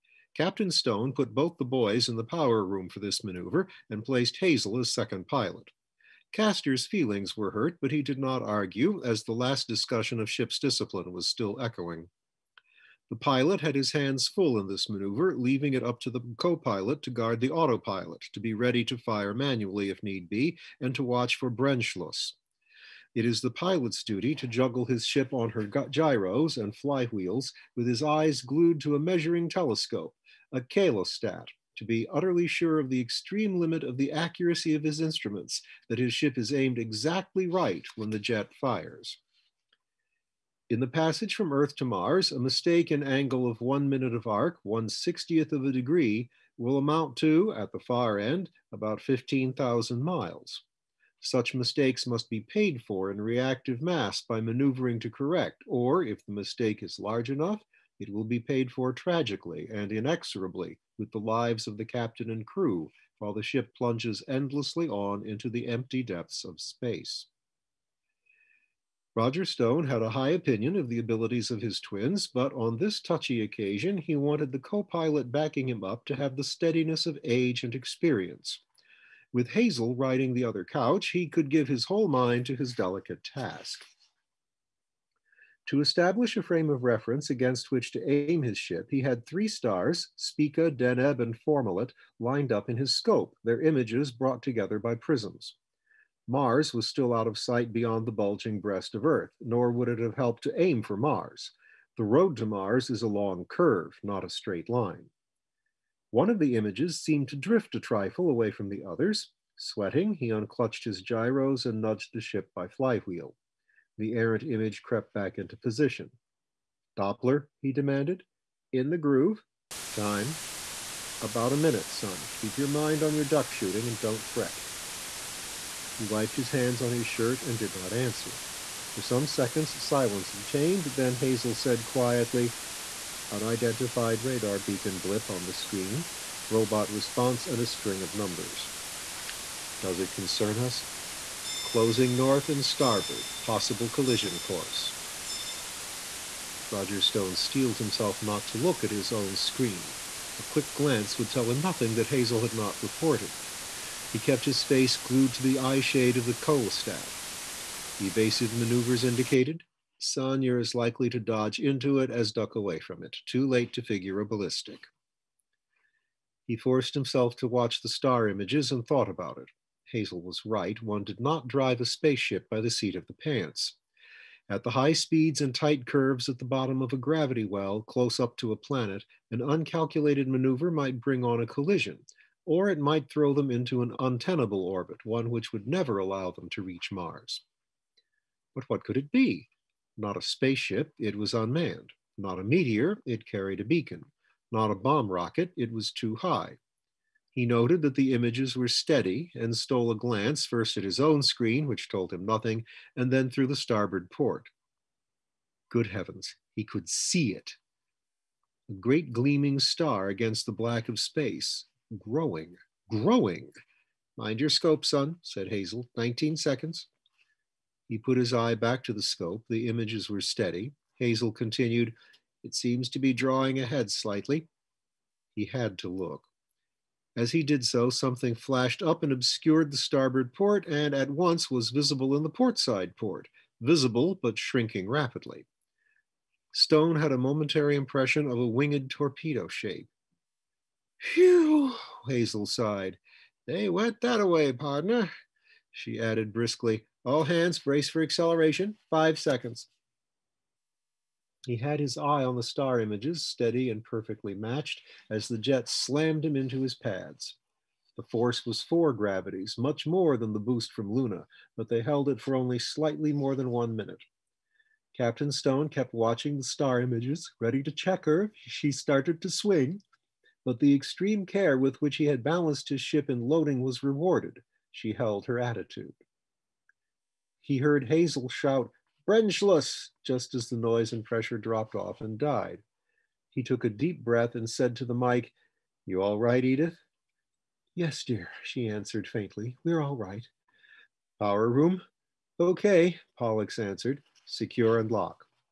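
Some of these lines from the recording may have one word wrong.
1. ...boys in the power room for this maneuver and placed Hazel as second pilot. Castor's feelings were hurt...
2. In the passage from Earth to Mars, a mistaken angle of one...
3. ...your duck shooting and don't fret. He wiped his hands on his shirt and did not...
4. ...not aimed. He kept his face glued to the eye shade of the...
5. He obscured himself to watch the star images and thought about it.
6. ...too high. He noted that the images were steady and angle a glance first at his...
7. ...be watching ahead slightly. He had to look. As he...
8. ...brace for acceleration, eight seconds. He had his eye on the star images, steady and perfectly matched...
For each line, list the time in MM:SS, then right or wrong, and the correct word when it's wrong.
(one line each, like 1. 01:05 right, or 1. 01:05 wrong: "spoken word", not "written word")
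1. 00:01 right
2. 00:40 right
3. 02:03 right
4. 02:32 wrong: "reported", not "aimed"
5. 02:46 wrong: "forced", not "obscured"
6. 03:15 wrong: "stole", not "angle"
7. 03:42 wrong: "drawing", not "watching"
8. 04:07 wrong: "five", not "eight".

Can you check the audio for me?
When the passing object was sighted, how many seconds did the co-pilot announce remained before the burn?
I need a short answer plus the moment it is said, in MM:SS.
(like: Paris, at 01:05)
19, at 03:35.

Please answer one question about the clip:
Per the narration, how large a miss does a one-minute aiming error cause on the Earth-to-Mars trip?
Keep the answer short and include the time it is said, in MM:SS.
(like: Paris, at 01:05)
15,000 miles, at 00:48.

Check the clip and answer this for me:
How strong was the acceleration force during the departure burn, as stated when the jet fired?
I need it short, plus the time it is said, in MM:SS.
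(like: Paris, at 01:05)
4 gravities, at 04:18.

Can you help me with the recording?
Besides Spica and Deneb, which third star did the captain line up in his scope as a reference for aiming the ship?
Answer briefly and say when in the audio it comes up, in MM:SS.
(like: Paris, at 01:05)
Fomalhaut, at 01:31.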